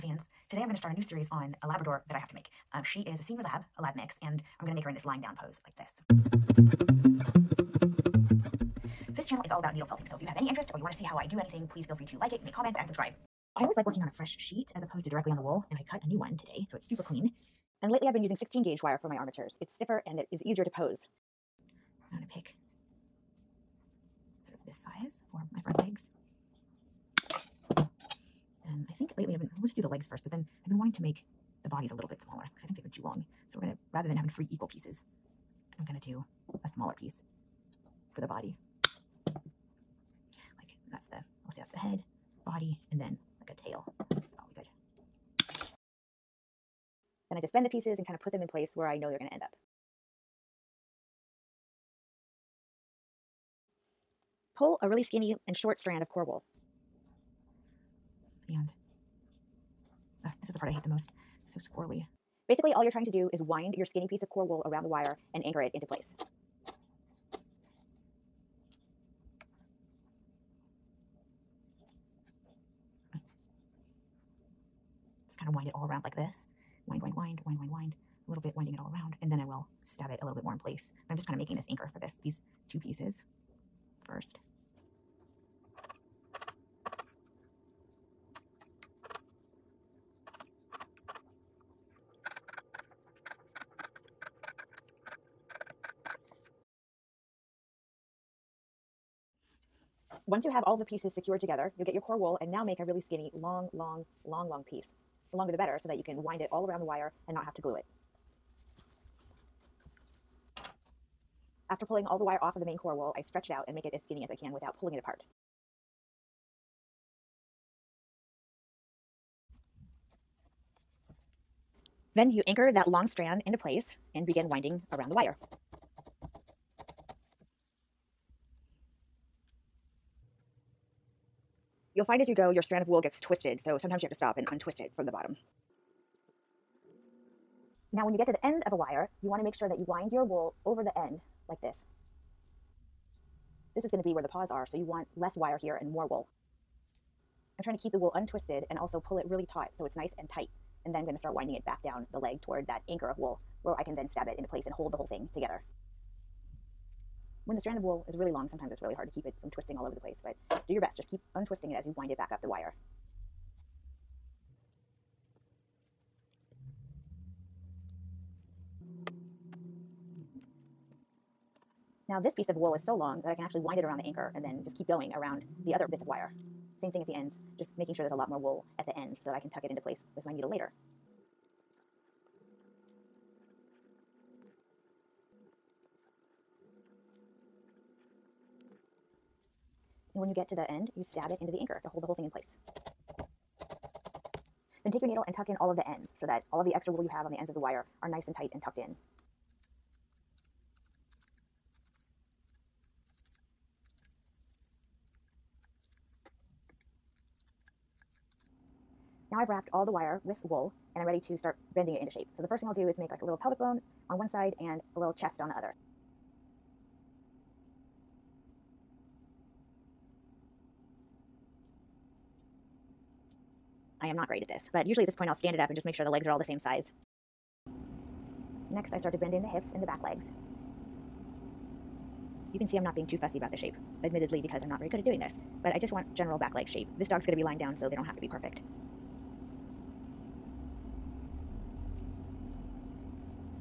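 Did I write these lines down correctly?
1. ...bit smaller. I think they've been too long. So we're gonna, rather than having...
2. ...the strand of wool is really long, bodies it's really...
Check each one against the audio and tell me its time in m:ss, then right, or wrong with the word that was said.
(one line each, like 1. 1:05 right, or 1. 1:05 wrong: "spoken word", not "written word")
1. 0:32 right
2. 2:37 wrong: "sometimes", not "bodies".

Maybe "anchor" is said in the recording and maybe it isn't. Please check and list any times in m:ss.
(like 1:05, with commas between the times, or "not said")
1:05, 1:21, 2:02, 2:32, 2:54, 3:11.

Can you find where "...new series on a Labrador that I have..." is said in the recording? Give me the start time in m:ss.
0:00.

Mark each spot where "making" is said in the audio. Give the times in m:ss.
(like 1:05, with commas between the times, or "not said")
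1:21, 2:57.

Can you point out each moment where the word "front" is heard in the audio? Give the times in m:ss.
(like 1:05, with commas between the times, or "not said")
0:25.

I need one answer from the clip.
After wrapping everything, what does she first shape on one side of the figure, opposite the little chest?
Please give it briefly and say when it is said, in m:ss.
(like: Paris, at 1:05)
pelvic bone, at 3:33.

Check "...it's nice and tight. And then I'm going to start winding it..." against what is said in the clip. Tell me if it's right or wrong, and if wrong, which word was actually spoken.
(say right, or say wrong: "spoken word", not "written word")
right.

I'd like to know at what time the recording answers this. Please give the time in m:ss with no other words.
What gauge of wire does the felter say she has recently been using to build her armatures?
0:18.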